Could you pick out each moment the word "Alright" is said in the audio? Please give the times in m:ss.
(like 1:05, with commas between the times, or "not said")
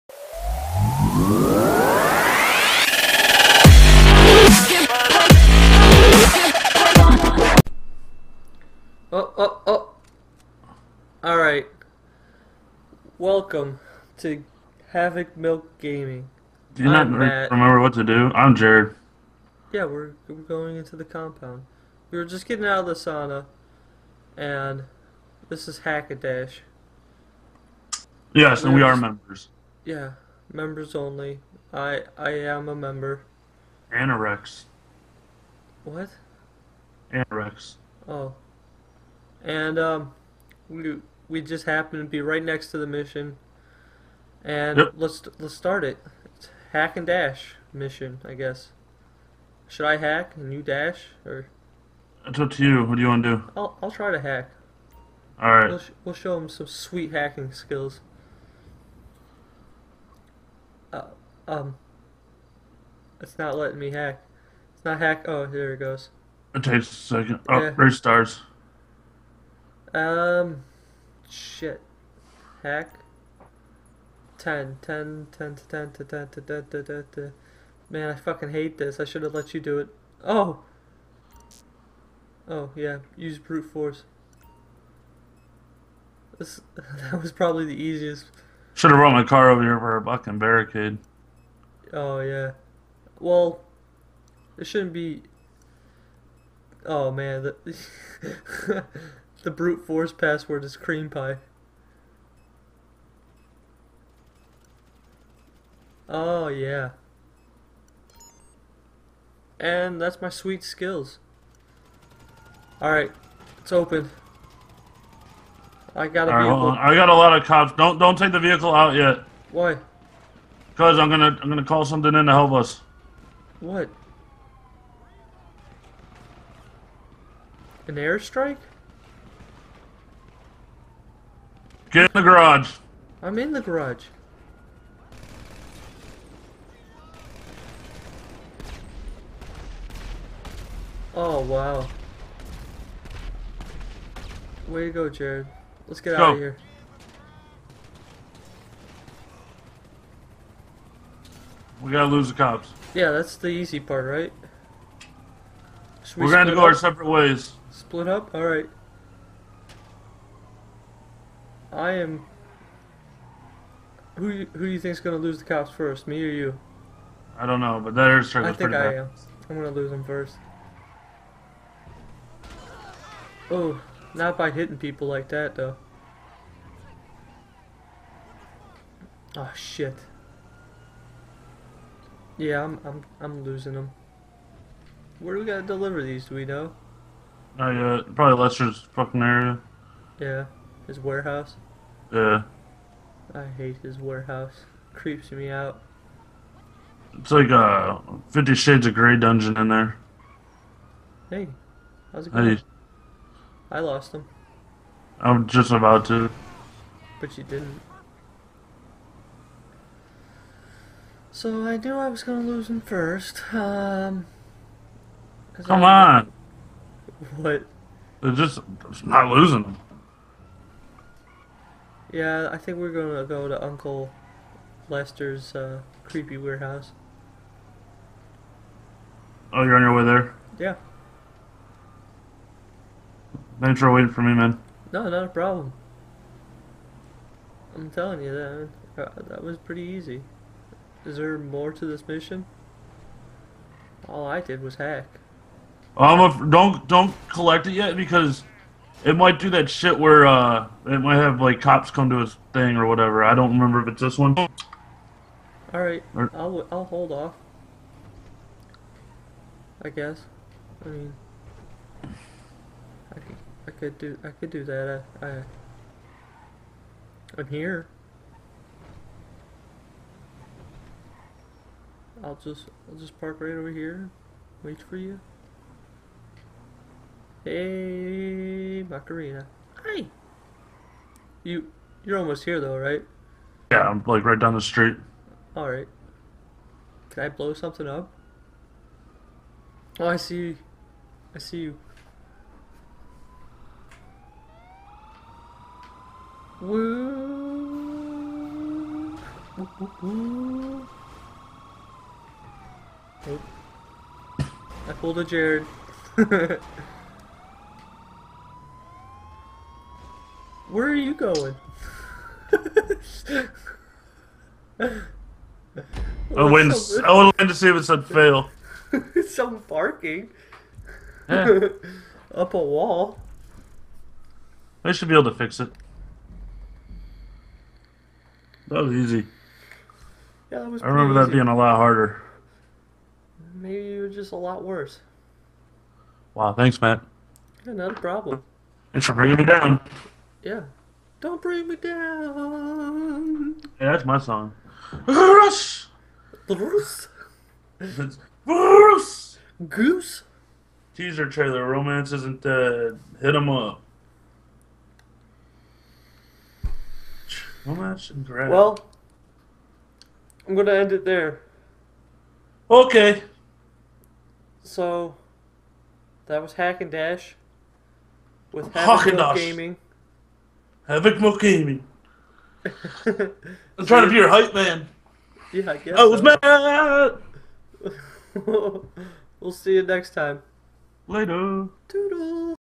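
0:11, 1:52, 2:38.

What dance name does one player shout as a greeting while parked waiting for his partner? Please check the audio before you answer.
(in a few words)
Macarena.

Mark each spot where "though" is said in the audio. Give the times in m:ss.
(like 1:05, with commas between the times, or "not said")
2:55, 4:42.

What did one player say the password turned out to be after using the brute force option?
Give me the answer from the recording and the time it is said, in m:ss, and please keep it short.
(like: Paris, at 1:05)
cream pie, at 1:40.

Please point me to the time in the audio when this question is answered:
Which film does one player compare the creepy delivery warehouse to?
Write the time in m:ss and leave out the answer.
3:18.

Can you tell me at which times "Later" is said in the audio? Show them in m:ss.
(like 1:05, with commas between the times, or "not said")
6:21.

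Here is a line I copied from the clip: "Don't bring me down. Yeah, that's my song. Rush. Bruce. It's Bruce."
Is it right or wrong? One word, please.
right.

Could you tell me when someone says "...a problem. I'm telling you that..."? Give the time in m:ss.
3:55.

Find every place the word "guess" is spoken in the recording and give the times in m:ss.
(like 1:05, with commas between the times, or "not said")
0:48, 4:19, 6:15.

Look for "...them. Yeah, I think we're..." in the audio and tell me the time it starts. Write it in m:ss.
3:39.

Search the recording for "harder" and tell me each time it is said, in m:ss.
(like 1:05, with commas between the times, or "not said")
5:31.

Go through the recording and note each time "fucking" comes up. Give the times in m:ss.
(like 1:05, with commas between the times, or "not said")
1:18, 1:30, 3:08.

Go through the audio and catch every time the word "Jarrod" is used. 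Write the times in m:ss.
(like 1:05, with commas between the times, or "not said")
0:18, 2:25, 5:05.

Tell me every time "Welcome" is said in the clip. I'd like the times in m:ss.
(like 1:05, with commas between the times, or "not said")
0:13.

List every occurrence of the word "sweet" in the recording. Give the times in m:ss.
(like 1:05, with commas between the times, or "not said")
0:56, 1:50.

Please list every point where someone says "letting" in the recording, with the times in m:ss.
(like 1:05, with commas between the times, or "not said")
1:03.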